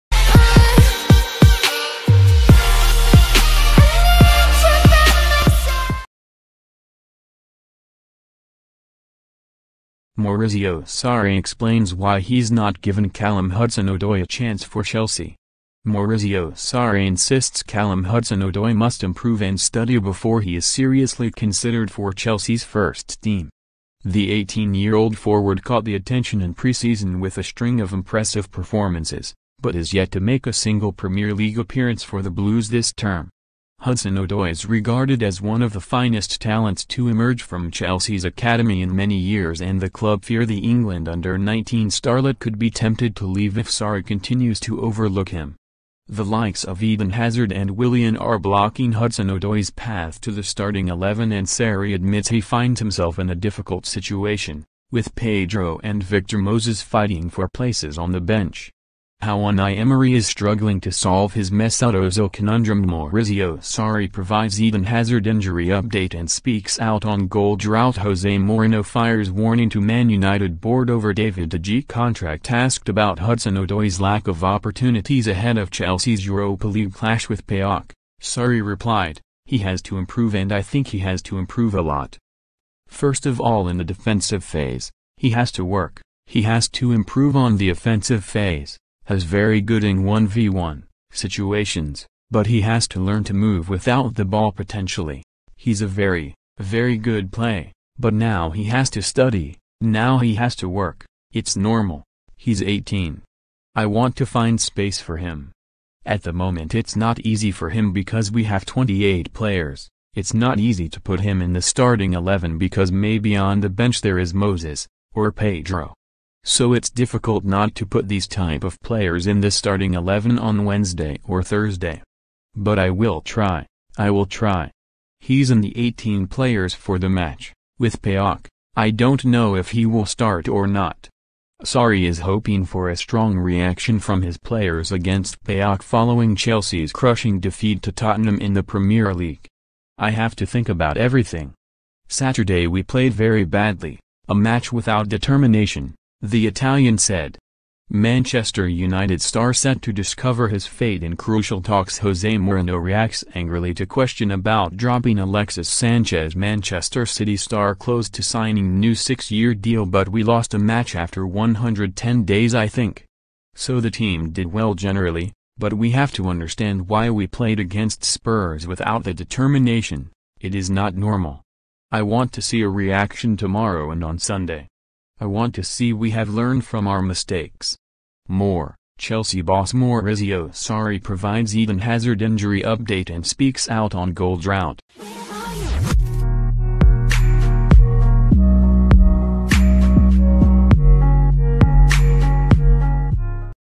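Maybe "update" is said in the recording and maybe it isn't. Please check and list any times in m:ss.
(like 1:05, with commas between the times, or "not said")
1:05, 3:02.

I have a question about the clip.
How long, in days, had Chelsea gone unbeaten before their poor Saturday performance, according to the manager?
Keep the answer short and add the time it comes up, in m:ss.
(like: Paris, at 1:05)
110 days, at 2:41.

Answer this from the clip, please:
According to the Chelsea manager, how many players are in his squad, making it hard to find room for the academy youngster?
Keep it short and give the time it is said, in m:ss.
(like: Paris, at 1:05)
28, at 1:48.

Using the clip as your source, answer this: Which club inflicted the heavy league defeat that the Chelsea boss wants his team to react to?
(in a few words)
Tottenham.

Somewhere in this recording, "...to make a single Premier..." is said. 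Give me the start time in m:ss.
0:30.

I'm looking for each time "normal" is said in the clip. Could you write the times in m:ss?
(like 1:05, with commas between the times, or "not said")
1:41, 2:50.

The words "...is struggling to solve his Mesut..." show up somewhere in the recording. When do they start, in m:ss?
1:00.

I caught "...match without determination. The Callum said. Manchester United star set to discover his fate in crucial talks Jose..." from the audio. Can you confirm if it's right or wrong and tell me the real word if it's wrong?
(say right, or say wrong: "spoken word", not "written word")
wrong: "Italian", not "Callum".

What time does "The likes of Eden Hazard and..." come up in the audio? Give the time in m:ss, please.
0:46.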